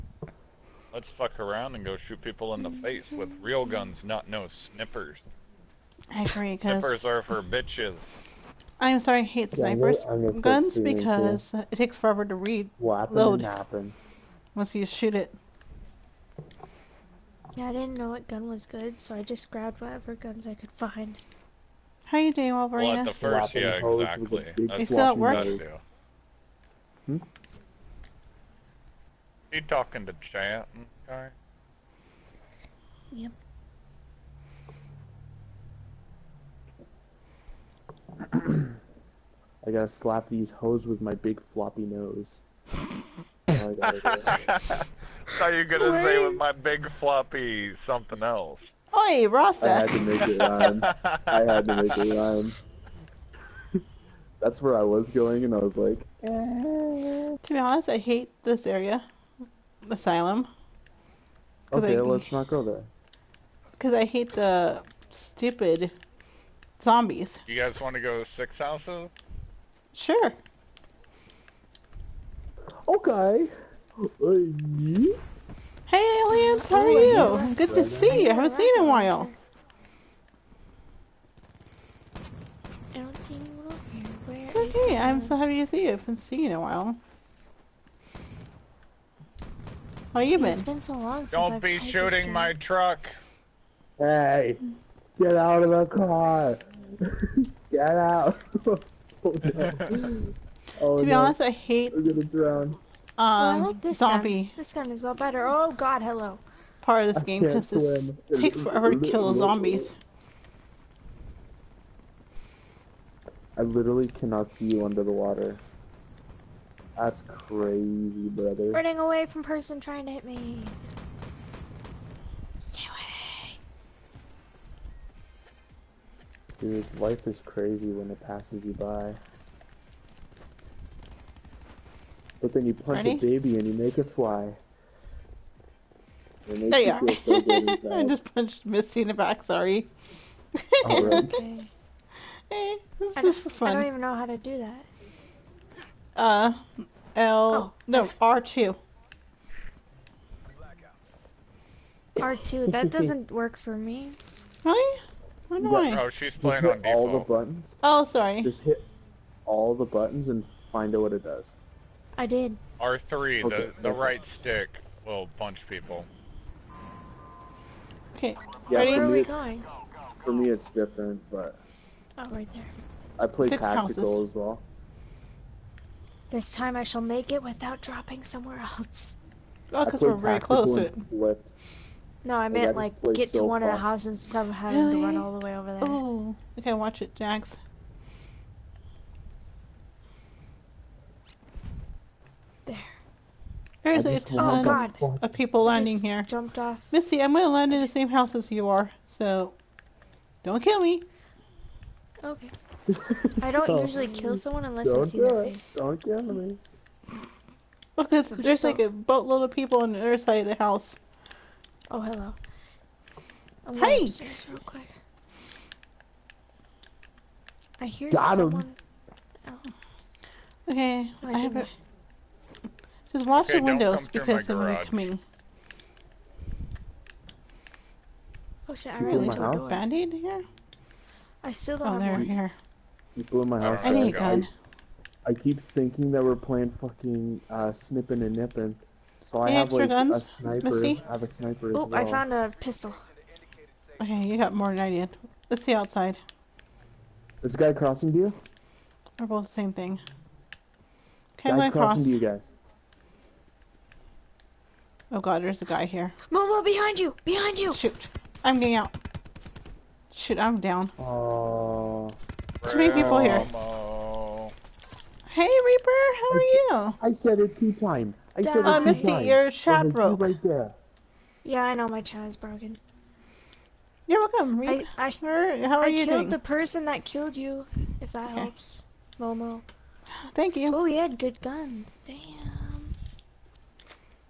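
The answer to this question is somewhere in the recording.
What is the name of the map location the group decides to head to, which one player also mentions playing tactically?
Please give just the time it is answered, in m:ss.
1:08.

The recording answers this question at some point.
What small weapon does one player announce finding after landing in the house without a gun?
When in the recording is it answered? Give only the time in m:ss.
4:02.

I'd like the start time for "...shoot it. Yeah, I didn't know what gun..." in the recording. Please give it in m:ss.
0:14.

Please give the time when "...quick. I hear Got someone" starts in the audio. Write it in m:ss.
3:34.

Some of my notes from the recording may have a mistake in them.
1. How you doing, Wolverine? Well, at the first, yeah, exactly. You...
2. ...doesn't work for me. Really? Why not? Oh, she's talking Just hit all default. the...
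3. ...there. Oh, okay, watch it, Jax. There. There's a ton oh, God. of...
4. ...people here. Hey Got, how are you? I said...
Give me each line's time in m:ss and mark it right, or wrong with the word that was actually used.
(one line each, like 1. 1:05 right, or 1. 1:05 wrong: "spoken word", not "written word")
1. 0:22 right
2. 2:32 wrong: "playing", not "talking"
3. 3:05 right
4. 4:22 wrong: "Reaper", not "Got".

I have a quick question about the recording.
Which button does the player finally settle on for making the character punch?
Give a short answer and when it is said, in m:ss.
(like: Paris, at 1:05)
R3, at 2:42.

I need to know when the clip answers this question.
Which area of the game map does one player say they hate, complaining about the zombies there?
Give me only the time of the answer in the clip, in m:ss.
0:59.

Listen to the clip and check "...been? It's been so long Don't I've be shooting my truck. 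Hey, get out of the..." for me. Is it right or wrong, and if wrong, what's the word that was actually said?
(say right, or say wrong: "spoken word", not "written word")
right.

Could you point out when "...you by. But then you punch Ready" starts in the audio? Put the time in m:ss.
2:08.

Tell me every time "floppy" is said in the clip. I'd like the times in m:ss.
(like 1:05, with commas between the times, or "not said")
0:41, 0:46.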